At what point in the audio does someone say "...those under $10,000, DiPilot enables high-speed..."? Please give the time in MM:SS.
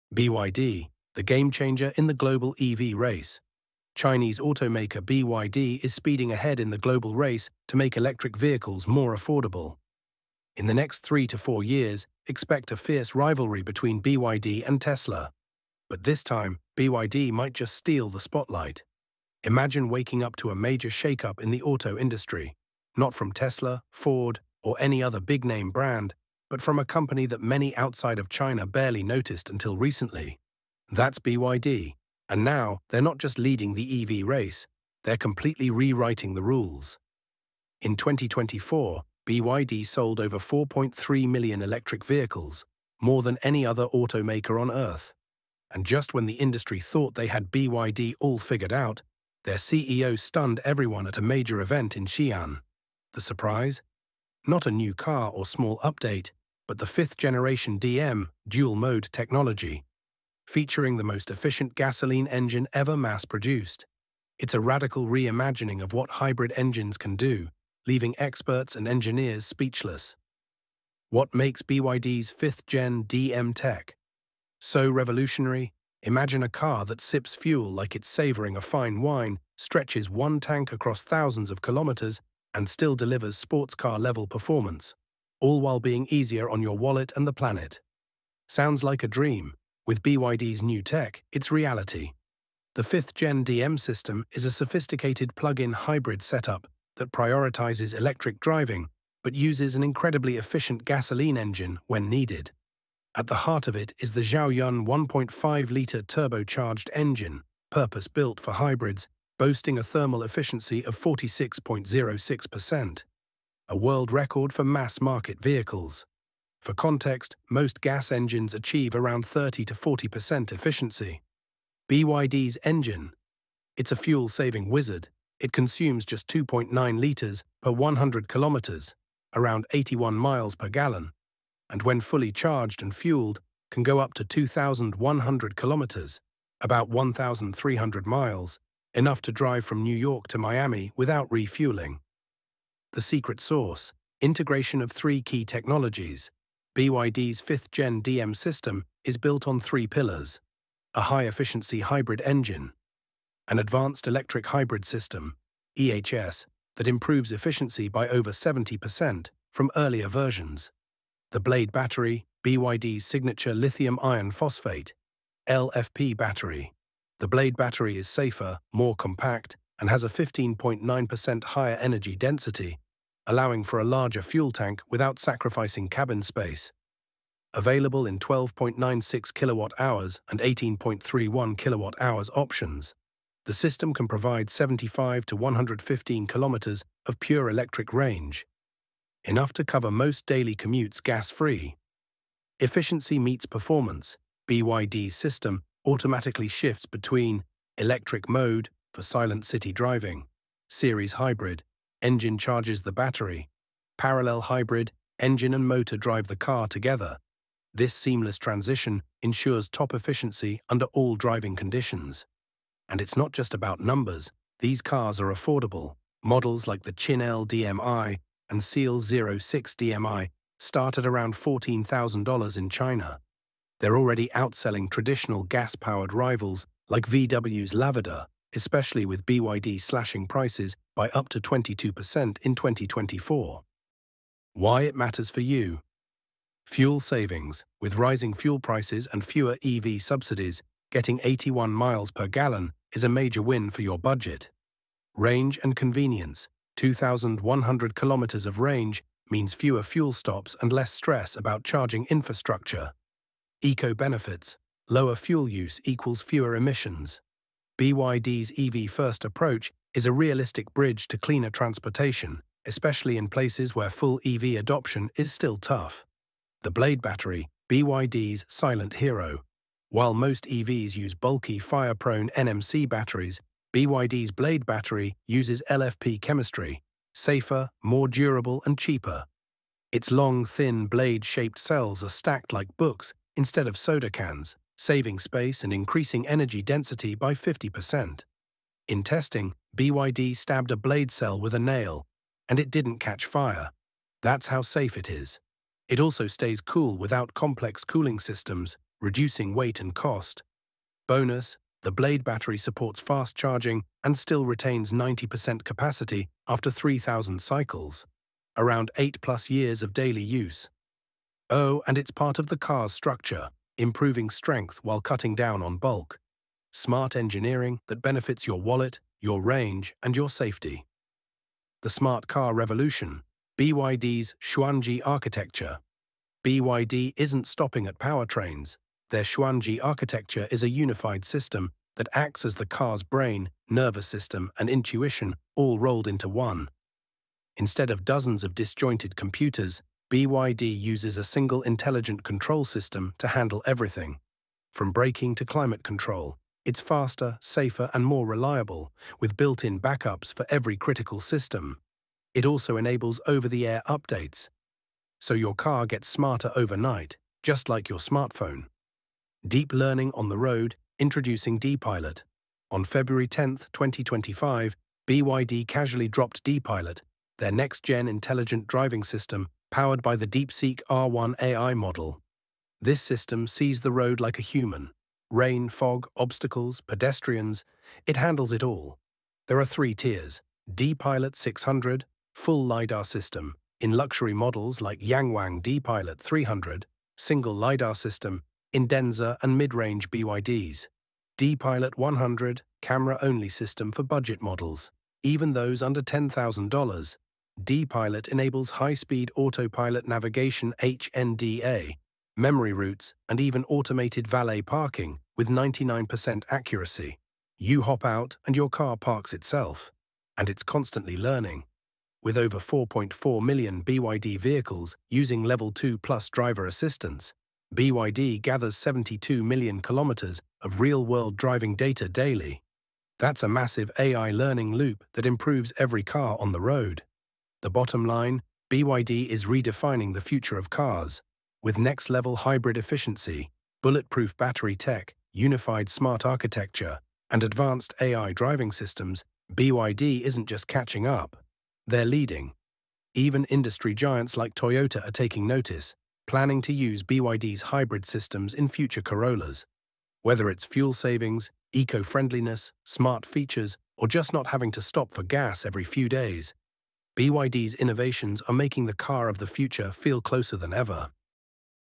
06:35.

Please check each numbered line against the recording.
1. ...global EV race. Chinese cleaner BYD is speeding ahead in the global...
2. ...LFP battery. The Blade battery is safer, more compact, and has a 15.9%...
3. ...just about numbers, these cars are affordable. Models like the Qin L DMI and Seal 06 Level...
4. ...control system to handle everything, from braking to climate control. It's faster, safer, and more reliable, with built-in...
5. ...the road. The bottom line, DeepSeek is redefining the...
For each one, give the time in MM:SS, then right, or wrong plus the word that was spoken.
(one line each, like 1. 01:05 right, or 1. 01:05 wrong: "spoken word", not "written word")
1. 00:02 wrong: "automaker", not "cleaner"
2. 02:45 right
3. 03:33 wrong: "DMI", not "Level"
4. 05:42 right
5. 07:06 wrong: "BYD", not "DeepSeek".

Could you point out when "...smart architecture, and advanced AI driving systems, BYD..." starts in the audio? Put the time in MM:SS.
07:15.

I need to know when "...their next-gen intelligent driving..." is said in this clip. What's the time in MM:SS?
06:07.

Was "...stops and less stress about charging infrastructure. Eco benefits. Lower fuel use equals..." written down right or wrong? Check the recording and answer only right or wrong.
right.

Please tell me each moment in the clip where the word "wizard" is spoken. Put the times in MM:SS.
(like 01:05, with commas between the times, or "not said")
02:04.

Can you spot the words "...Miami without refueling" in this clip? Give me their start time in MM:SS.
02:20.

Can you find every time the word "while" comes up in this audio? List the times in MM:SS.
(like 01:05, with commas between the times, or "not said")
01:25, 04:29, 05:14.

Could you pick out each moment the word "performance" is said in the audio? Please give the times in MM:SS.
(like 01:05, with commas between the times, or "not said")
01:24, 03:13.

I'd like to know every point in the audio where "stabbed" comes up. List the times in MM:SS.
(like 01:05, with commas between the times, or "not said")
04:50.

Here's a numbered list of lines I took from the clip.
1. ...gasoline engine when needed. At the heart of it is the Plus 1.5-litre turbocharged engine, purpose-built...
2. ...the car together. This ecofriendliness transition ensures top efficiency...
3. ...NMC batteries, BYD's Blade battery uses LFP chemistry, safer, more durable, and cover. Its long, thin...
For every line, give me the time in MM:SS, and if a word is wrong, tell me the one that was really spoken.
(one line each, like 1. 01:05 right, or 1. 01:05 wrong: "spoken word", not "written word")
1. 01:40 wrong: "Xiaoyun", not "Plus"
2. 03:26 wrong: "seamless", not "ecofriendliness"
3. 04:32 wrong: "cheaper", not "cover".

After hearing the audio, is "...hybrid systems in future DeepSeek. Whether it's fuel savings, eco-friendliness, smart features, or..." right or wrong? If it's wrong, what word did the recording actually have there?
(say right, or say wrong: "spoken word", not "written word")
wrong: "Corollas", not "DeepSeek".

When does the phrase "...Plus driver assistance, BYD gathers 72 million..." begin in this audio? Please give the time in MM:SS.
06:55.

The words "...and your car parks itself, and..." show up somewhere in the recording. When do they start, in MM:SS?
06:48.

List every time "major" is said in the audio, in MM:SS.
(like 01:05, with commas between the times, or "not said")
00:20, 00:51, 04:03.